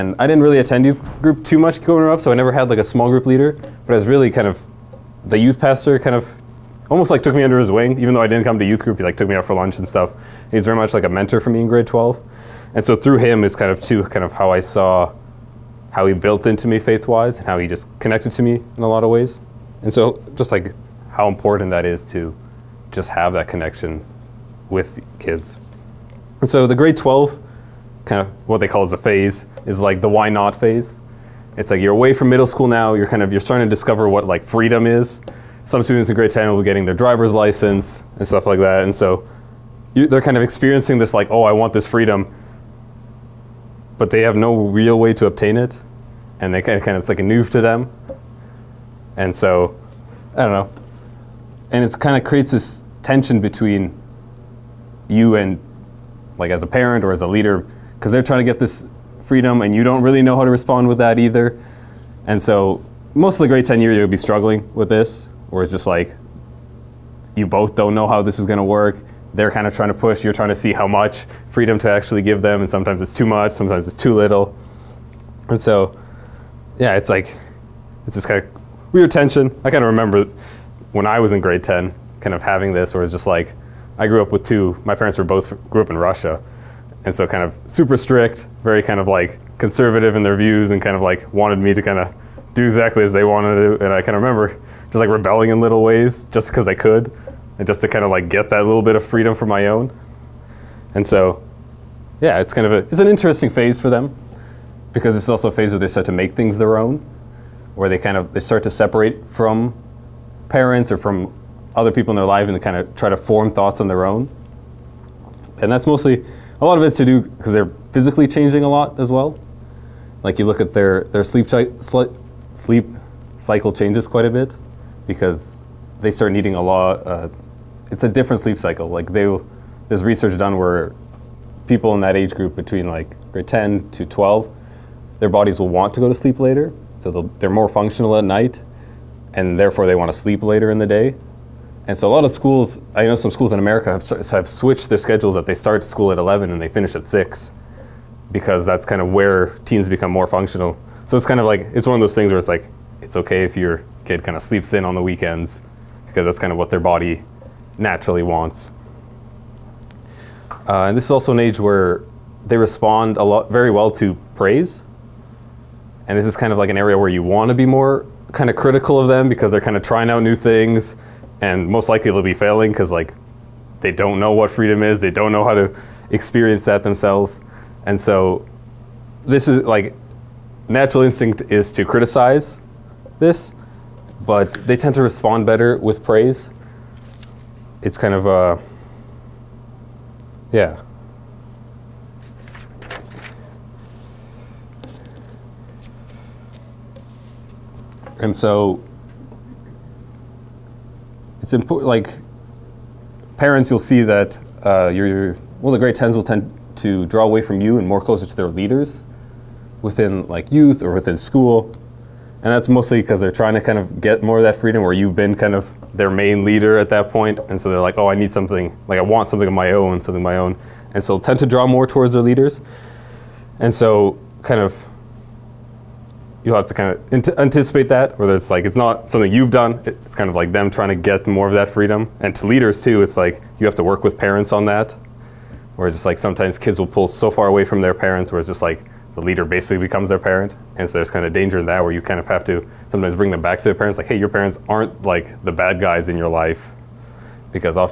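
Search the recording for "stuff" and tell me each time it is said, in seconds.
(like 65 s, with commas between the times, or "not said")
9 s, 38 s.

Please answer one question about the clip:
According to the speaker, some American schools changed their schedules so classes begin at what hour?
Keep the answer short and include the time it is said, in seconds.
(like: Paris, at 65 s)
11, at 146 s.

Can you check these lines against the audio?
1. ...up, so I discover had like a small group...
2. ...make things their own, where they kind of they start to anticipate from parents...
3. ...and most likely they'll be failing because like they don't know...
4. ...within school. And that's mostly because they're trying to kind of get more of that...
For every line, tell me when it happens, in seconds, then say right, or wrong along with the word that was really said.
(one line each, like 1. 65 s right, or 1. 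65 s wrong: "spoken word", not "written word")
1. 2 s wrong: "never", not "discover"
2. 106 s wrong: "separate", not "anticipate"
3. 171 s right
4. 210 s right.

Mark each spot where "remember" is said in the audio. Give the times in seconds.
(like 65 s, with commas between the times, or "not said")
79 s, 94 s.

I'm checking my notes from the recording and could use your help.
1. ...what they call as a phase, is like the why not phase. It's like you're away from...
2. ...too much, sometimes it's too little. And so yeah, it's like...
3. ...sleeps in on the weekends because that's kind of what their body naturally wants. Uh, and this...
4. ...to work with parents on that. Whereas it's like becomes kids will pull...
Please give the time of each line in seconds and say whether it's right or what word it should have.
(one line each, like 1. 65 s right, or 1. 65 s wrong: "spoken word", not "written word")
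1. 28 s right
2. 73 s right
3. 154 s right
4. 233 s wrong: "sometimes", not "becomes".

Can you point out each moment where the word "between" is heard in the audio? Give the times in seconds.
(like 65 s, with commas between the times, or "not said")
53 s, 132 s.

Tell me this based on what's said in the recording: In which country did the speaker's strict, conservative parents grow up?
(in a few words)
Russia.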